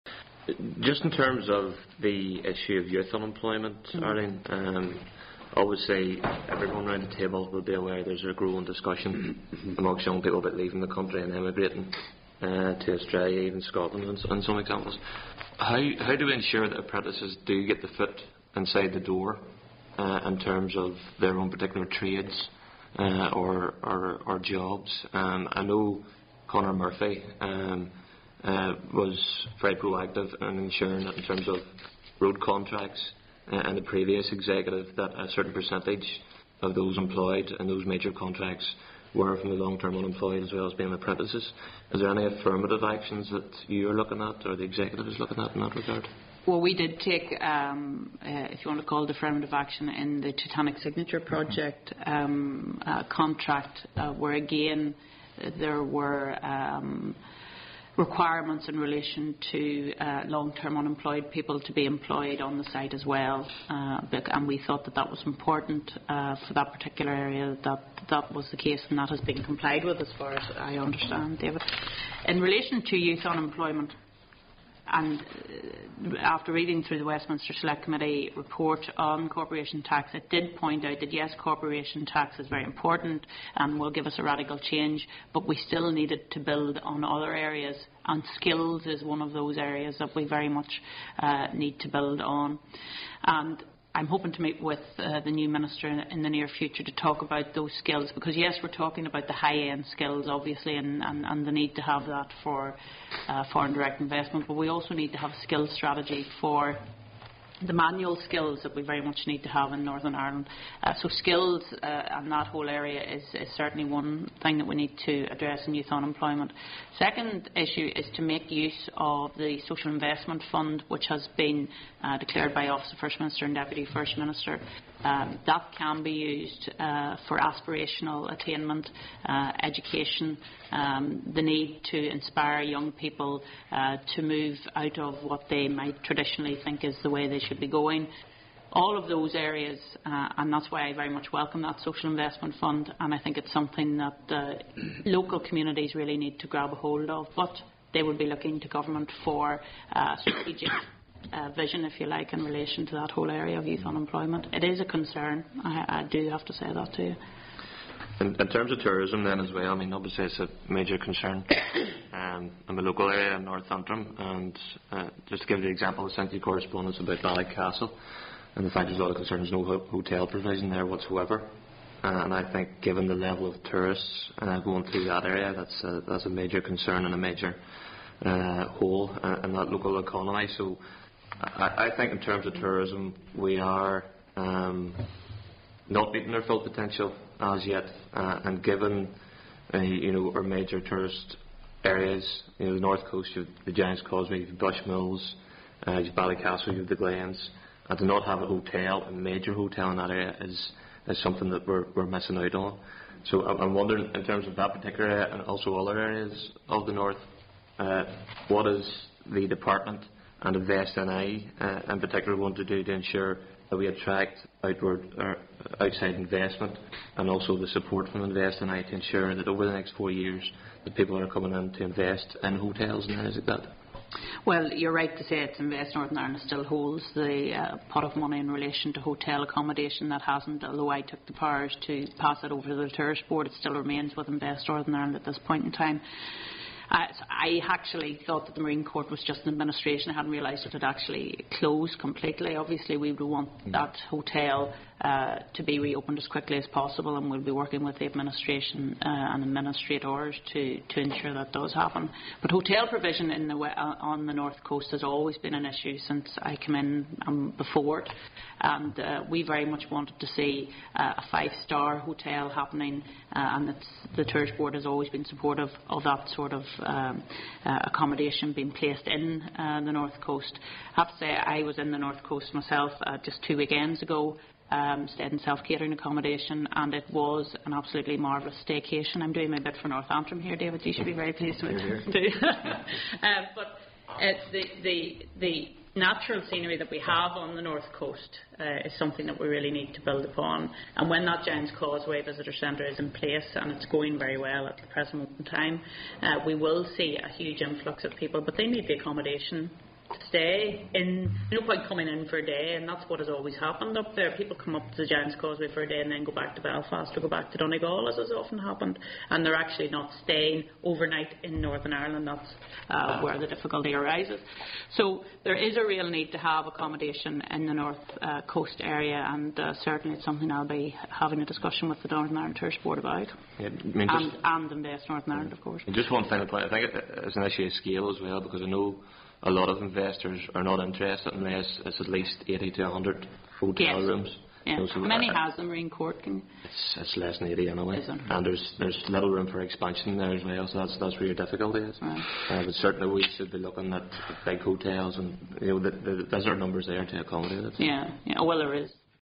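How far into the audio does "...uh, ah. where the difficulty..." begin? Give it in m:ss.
5:12.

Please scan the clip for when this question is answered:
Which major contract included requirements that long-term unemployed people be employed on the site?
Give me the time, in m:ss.
0:50.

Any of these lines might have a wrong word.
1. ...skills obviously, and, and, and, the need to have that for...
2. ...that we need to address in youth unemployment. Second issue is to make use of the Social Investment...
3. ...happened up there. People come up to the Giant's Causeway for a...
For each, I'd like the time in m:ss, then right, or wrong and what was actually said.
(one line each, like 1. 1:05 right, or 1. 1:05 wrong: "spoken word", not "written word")
1. 1:39 right
2. 1:54 right
3. 5:03 right.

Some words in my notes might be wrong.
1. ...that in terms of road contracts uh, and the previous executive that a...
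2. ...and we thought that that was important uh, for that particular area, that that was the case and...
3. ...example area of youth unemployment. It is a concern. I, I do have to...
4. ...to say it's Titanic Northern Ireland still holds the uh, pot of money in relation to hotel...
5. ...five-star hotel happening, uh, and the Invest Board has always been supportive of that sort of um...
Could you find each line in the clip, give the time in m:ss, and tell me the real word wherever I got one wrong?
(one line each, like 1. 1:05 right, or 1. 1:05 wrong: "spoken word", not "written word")
1. 0:31 right
2. 1:04 right
3. 2:33 wrong: "whole", not "example"
4. 3:45 wrong: "Invest", not "Titanic"
5. 4:21 wrong: "Tourist", not "Invest".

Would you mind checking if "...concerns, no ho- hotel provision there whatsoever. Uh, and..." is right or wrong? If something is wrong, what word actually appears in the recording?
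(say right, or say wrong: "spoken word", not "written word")
right.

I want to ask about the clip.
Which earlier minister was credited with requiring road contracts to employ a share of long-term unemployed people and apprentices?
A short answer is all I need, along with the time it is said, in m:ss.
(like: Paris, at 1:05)
Conor Murphy, at 0:26.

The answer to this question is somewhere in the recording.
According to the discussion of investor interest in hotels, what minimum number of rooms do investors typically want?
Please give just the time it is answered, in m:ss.
5:32.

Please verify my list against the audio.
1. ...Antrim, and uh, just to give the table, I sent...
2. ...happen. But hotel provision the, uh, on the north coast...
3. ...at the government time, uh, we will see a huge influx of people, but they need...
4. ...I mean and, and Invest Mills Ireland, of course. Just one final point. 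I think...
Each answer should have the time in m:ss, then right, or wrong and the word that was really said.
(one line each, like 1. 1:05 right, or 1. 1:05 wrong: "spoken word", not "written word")
1. 2:43 wrong: "example", not "table"
2. 4:11 right
3. 4:54 wrong: "present", not "government"
4. 5:23 wrong: "Northern", not "Mills".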